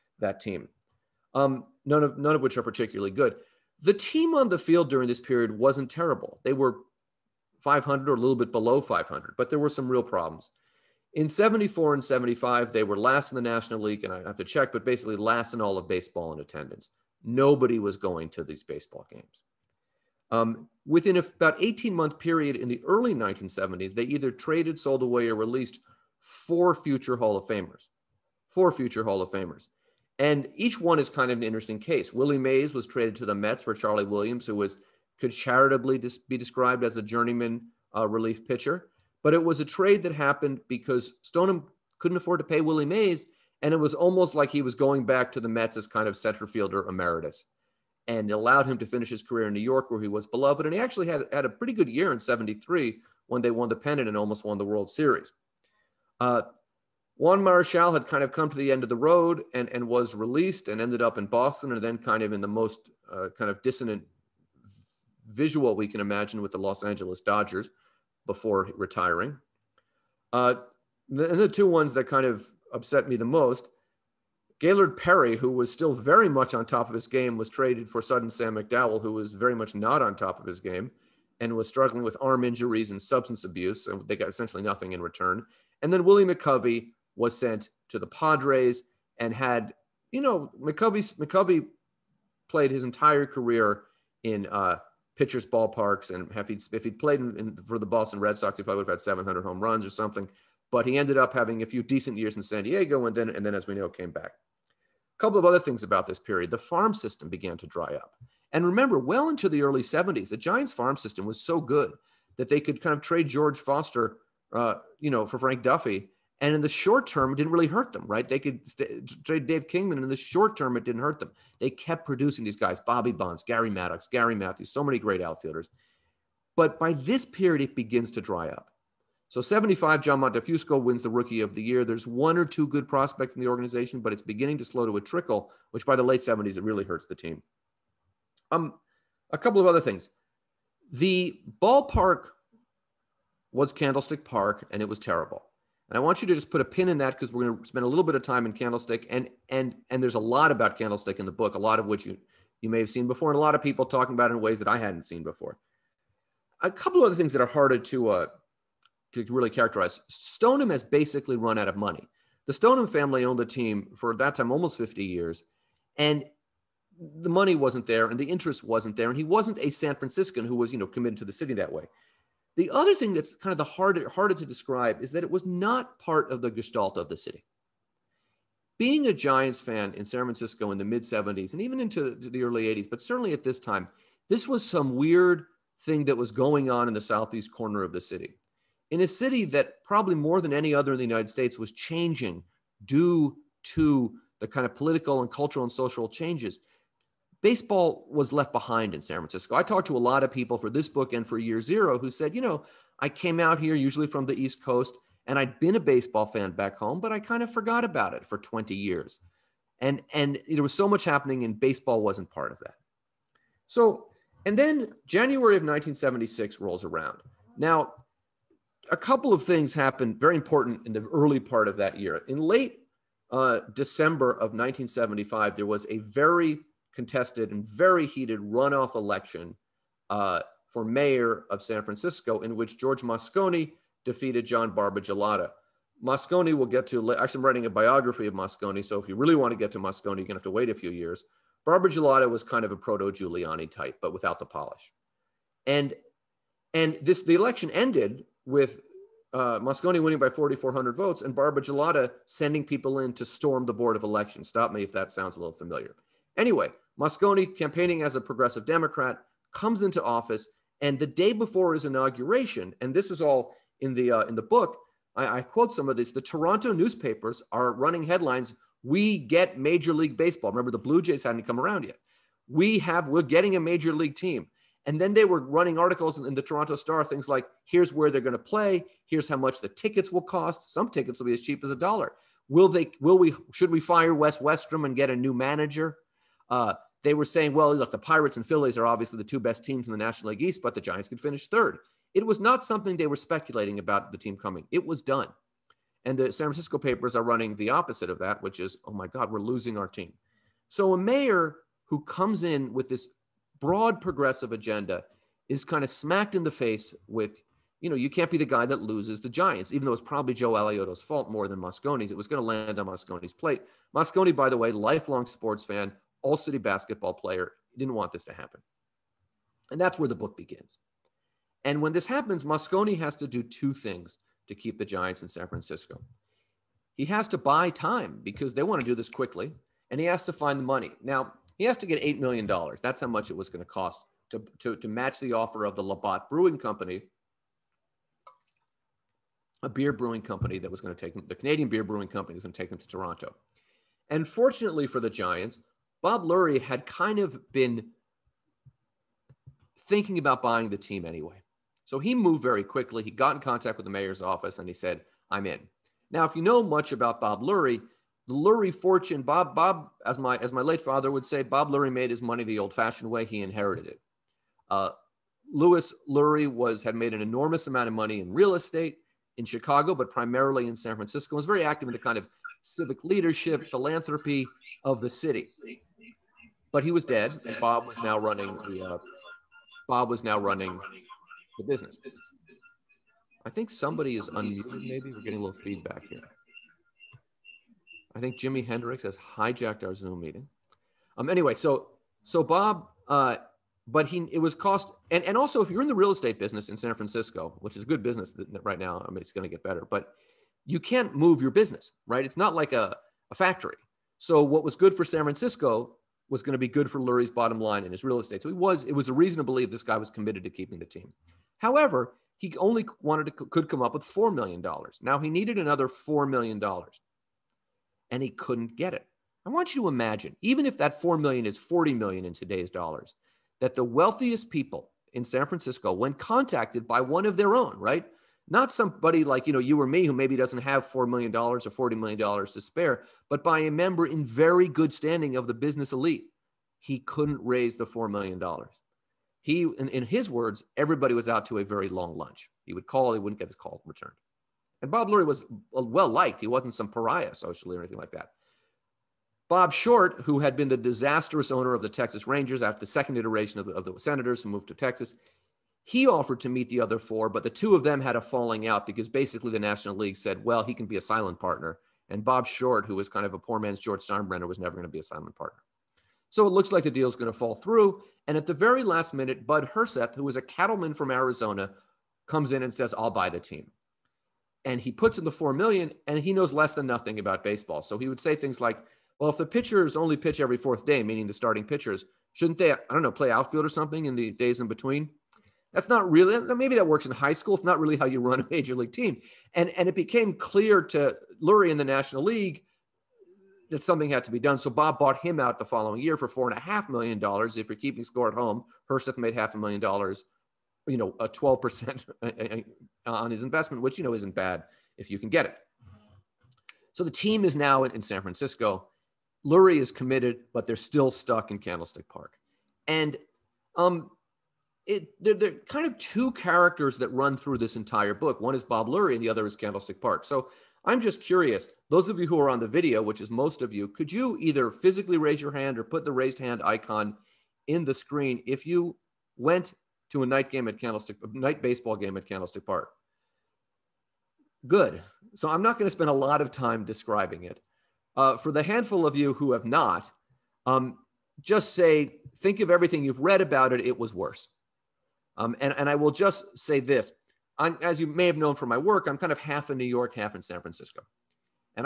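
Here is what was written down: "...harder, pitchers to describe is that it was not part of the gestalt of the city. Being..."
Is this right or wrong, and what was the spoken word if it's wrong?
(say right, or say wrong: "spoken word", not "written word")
wrong: "harder", not "pitchers".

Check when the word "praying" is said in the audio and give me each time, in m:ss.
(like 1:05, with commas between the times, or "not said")
not said.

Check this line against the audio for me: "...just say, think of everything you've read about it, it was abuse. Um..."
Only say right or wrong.
wrong.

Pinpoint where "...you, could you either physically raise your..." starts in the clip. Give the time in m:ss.
8:43.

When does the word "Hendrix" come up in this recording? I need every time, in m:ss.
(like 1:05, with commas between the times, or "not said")
6:28.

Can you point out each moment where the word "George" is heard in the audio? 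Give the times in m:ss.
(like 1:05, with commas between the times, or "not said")
1:53, 3:52, 7:43.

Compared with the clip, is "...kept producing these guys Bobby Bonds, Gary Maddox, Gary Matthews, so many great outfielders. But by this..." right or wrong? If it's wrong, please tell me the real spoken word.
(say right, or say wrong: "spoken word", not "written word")
right.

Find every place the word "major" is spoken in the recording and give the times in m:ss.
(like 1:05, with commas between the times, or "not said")
4:29, 4:33, 8:08.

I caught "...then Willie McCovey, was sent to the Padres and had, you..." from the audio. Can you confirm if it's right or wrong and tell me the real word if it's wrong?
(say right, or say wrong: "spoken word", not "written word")
right.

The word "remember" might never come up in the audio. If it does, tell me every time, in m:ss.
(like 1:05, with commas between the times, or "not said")
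1:48, 4:30.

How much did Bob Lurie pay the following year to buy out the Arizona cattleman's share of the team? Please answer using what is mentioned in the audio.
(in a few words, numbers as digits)
$4.5 million.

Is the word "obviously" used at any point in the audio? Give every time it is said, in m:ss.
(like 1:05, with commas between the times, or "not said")
4:48.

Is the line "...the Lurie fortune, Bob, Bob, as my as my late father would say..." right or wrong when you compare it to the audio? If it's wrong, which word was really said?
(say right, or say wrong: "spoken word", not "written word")
right.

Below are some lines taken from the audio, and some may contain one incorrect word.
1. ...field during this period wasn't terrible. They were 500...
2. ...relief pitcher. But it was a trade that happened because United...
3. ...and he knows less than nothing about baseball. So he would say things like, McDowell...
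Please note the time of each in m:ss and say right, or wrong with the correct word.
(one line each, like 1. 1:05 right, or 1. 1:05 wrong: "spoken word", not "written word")
1. 0:04 right
2. 0:38 wrong: "Stoneham", not "United"
3. 7:56 wrong: "Well", not "McDowell".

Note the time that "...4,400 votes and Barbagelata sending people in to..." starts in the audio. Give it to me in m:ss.
4:10.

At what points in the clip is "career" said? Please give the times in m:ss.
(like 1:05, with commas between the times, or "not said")
0:49, 1:33.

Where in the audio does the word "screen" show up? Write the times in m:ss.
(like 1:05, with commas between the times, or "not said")
8:47.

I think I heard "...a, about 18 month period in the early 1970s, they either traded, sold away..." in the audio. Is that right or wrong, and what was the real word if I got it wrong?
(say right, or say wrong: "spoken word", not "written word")
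right.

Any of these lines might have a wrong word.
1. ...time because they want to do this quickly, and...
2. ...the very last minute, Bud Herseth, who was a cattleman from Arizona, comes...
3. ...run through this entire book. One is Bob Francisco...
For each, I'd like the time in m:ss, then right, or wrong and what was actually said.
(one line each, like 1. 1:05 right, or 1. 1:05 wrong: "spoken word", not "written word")
1. 5:27 right
2. 7:48 right
3. 8:37 wrong: "Lurie", not "Francisco".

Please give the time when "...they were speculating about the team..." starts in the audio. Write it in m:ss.
4:52.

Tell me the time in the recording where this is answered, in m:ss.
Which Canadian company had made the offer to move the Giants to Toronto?
5:35.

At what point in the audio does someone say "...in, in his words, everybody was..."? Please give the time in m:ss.
7:19.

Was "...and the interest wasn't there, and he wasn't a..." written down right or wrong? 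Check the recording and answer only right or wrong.
right.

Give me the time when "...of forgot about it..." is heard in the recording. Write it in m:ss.
3:27.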